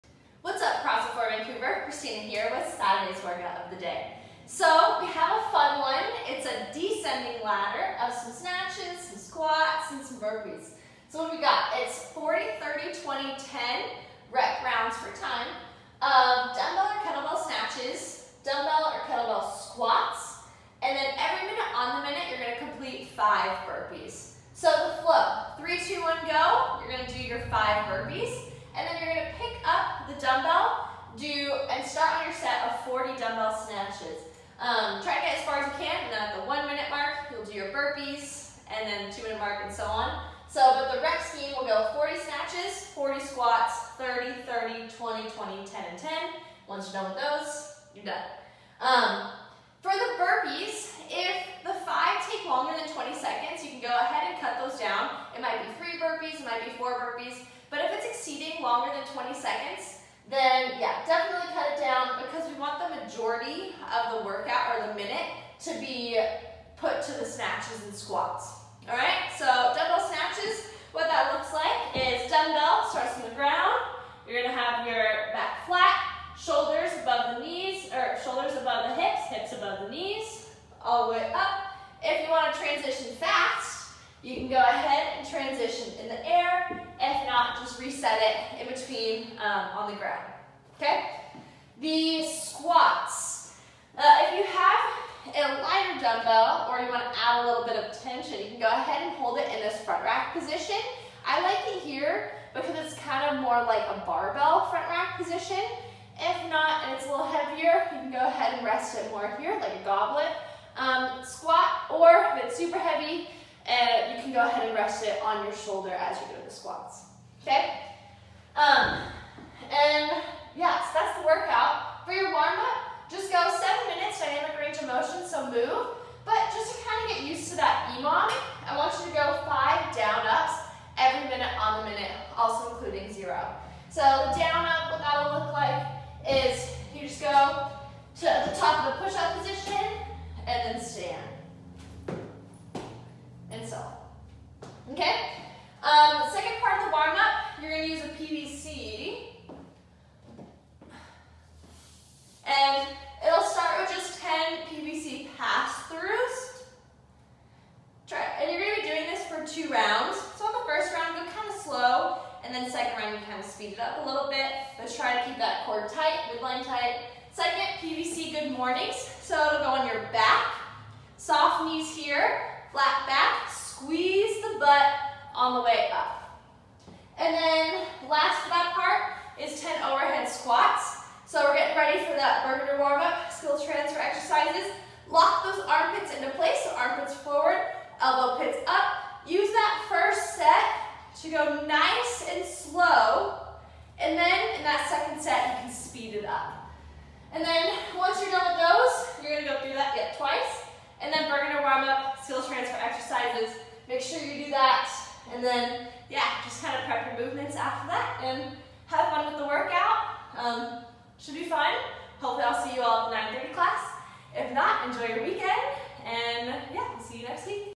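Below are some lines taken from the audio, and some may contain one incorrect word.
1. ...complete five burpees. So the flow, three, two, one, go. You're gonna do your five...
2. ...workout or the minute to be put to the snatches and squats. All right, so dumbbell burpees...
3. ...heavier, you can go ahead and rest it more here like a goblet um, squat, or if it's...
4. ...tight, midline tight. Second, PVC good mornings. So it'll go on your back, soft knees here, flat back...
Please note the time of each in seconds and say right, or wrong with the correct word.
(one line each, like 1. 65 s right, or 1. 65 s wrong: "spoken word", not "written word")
1. 22 s right
2. 64 s wrong: "snatches", not "burpees"
3. 107 s right
4. 165 s right.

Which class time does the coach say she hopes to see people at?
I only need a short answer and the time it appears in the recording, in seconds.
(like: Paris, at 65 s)
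9:30, at 213 s.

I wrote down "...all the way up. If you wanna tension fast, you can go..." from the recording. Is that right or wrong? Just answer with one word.
wrong.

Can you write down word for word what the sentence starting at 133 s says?
So down up, what that'll look like is you just go to the top of the push-up position and then stand.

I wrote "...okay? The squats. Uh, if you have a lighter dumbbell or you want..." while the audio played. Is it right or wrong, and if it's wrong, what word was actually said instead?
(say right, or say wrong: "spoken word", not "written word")
right.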